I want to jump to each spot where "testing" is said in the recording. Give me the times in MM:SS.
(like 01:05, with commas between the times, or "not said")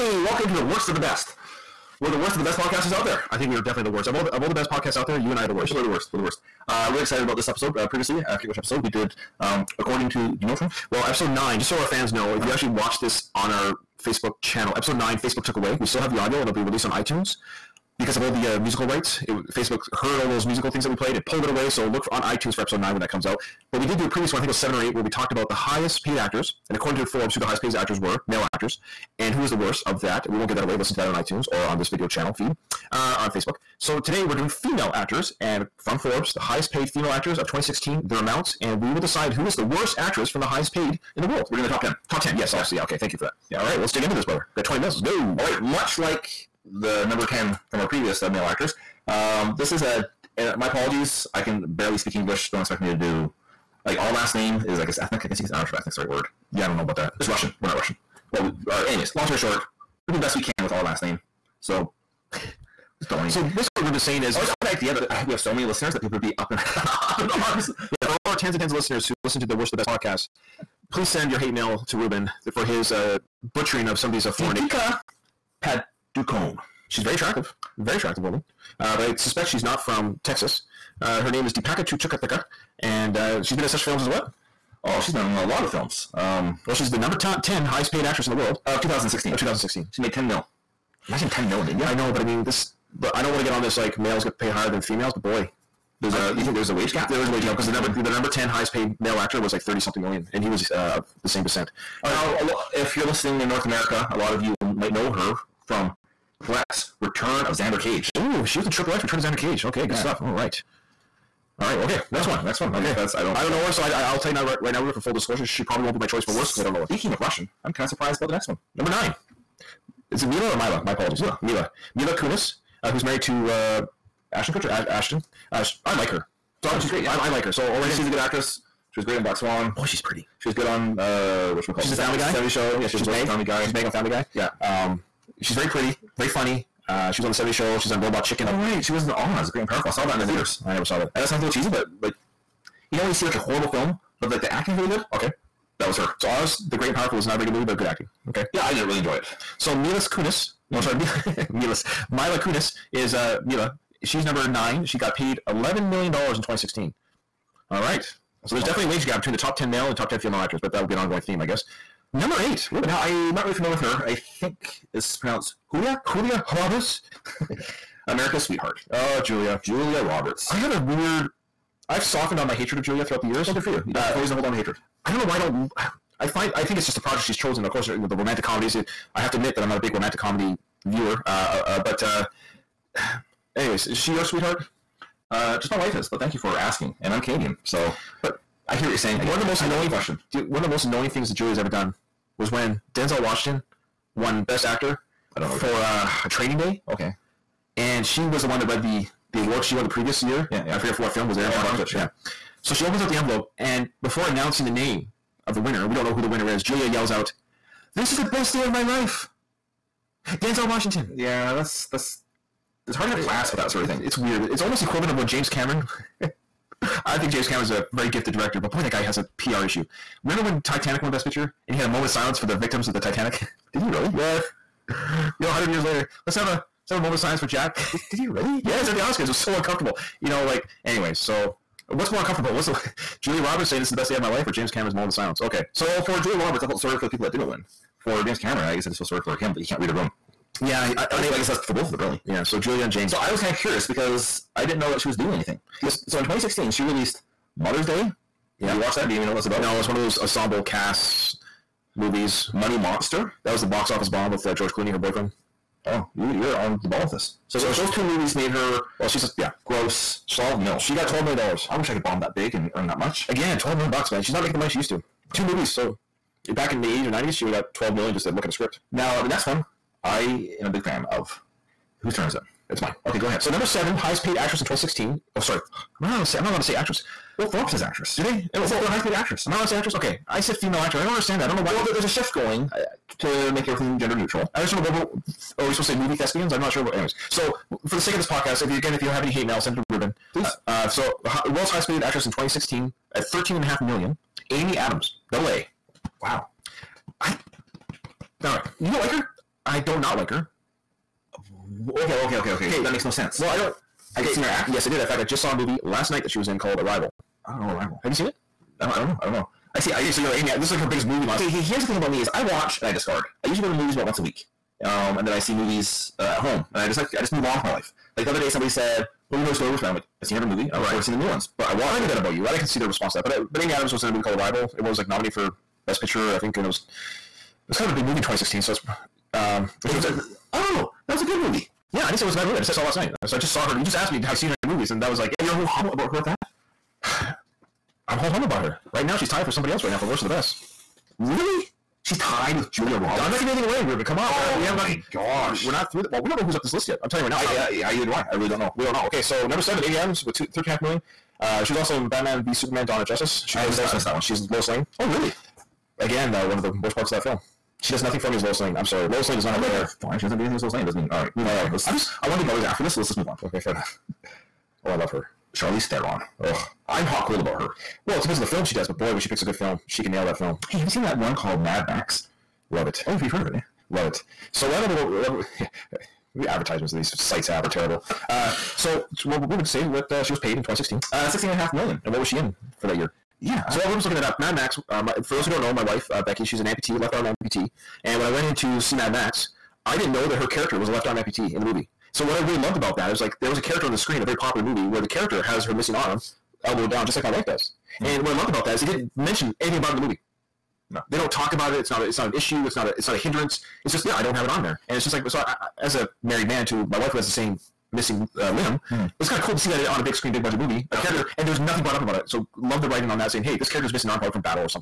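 not said.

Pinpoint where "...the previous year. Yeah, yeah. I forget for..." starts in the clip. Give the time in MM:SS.
03:19.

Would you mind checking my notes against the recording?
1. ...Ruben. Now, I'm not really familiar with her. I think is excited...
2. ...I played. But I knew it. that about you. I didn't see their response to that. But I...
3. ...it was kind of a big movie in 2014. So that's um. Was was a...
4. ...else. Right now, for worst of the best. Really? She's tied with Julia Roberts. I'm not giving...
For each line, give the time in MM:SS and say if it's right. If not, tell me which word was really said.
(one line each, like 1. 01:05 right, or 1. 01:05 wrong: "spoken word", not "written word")
1. 02:42 wrong: "pronounced", not "excited"
2. 05:21 wrong: "watched", not "played"
3. 05:26 wrong: "2016", not "2014"
4. 05:39 right.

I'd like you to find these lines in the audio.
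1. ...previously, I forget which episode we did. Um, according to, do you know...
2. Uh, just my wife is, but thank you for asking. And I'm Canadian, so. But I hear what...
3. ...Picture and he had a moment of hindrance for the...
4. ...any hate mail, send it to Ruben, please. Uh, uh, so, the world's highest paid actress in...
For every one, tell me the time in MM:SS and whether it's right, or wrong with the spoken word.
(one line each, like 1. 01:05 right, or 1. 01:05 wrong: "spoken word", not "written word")
1. 00:07 right
2. 03:05 right
3. 03:41 wrong: "silence", not "hindrance"
4. 04:49 right.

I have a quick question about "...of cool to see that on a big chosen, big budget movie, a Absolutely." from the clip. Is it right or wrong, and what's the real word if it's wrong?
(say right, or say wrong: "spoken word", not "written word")
wrong: "screen", not "chosen".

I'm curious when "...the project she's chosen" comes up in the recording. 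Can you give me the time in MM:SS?
02:56.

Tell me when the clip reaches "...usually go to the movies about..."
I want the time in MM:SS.
05:13.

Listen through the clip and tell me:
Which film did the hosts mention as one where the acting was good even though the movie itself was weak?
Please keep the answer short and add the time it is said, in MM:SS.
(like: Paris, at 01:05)
Oz the Great and Powerful, at 02:19.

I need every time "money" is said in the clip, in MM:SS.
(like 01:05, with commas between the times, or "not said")
04:12, 04:24.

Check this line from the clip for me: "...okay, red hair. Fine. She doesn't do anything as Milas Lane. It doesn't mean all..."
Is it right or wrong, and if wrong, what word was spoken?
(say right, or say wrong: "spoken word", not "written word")
wrong: "Lois", not "Milas".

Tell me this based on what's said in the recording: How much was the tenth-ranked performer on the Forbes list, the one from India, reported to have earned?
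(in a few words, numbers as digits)
10 million.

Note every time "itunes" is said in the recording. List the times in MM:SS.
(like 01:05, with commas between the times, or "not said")
00:16, 00:22, 00:31.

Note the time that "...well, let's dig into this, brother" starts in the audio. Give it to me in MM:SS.
00:43.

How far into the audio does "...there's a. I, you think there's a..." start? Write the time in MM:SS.
01:36.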